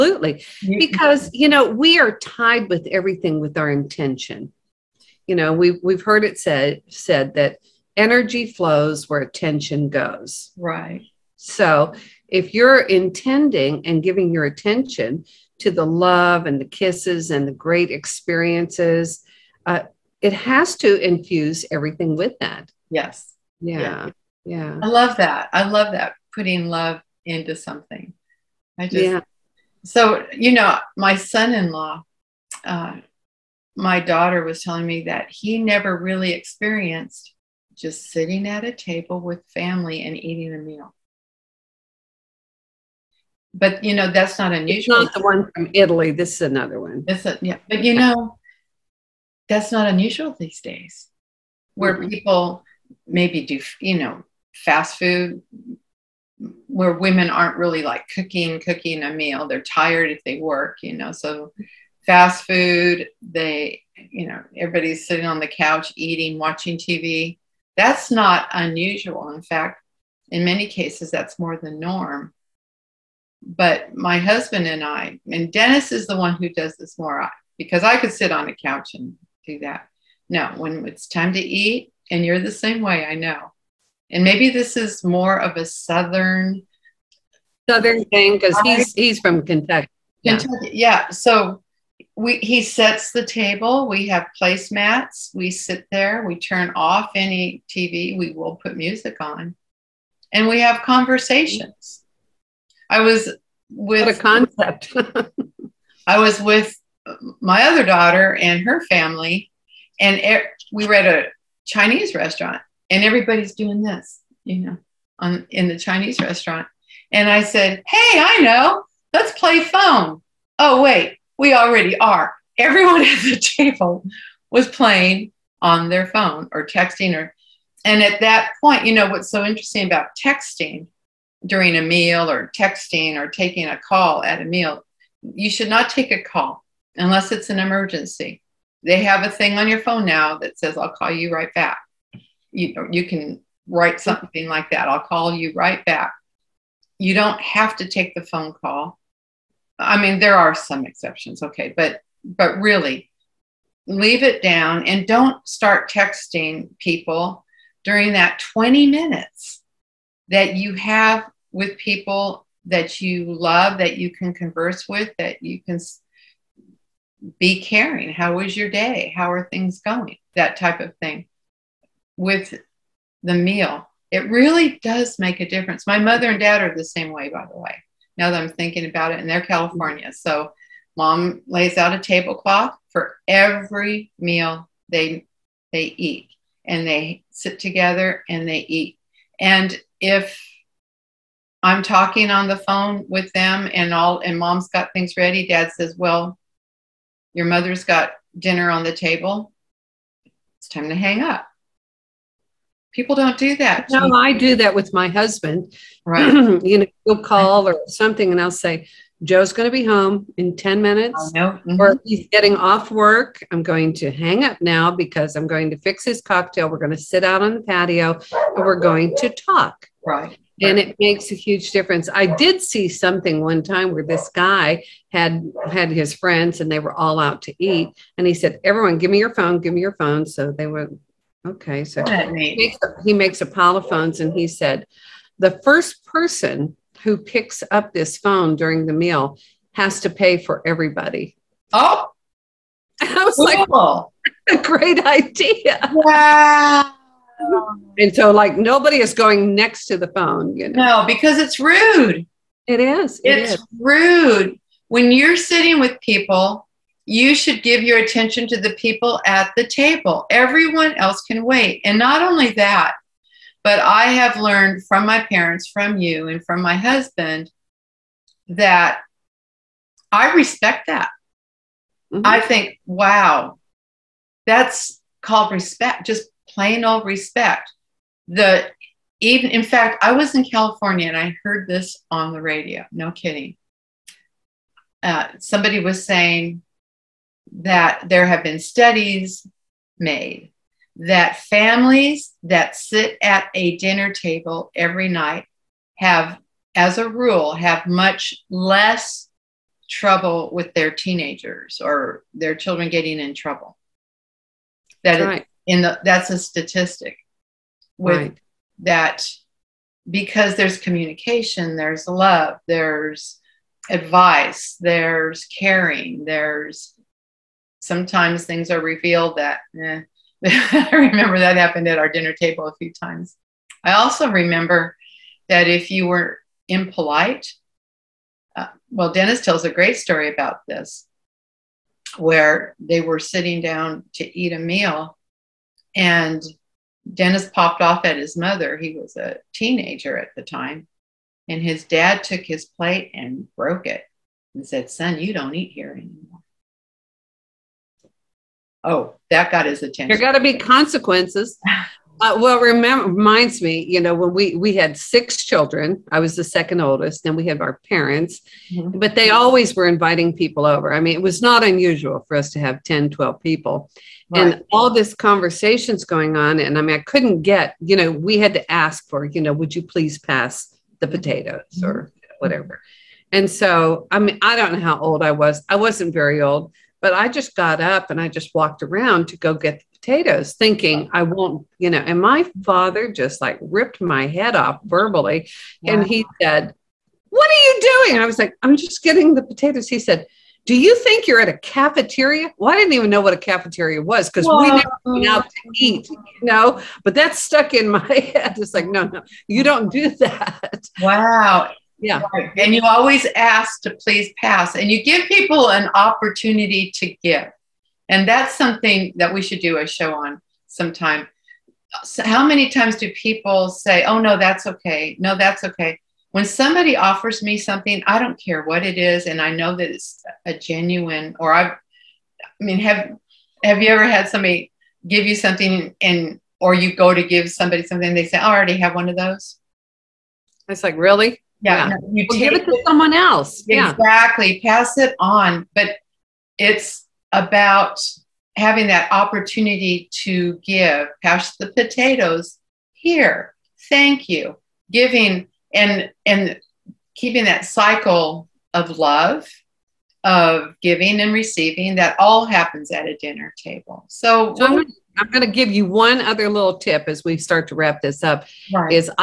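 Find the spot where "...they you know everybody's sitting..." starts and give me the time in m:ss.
1:03.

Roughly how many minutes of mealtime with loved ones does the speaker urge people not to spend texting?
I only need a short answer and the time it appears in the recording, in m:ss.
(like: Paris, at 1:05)
20, at 2:38.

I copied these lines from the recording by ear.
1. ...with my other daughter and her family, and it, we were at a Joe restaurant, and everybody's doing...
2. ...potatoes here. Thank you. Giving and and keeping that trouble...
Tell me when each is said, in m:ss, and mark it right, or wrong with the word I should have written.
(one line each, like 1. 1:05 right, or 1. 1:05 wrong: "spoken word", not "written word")
1. 1:46 wrong: "Chinese", not "Joe"
2. 7:21 wrong: "cycle", not "trouble".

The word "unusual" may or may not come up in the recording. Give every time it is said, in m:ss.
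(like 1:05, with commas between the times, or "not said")
0:44, 0:49, 1:08, 6:01.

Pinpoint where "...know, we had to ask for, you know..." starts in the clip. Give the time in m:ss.
6:07.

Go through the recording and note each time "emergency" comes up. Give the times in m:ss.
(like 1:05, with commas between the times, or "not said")
2:17.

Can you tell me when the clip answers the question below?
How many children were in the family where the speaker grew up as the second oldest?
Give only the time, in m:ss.
5:54.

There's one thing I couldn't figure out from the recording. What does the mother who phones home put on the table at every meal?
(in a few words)
tablecloth.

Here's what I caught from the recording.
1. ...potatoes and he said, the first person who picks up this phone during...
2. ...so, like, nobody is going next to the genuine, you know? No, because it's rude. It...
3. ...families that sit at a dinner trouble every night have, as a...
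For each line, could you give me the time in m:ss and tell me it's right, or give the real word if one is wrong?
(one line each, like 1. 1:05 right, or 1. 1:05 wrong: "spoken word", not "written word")
1. 3:53 wrong: "makes", not "potatoes"
2. 4:08 wrong: "phone", not "genuine"
3. 4:51 wrong: "table", not "trouble".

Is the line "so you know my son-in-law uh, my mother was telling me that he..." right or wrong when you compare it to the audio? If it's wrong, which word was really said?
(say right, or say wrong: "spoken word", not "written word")
wrong: "daughter", not "mother".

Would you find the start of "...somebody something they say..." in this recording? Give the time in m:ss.
7:07.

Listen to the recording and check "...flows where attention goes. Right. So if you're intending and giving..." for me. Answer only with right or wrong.
right.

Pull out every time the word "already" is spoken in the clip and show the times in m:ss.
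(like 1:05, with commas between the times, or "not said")
2:01, 7:08.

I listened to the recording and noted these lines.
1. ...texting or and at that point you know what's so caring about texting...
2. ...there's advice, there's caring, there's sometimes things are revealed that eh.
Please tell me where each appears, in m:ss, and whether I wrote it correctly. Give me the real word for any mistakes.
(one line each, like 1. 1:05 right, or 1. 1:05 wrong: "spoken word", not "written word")
1. 2:06 wrong: "interesting", not "caring"
2. 5:12 right.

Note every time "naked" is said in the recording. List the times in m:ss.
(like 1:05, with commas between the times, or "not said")
not said.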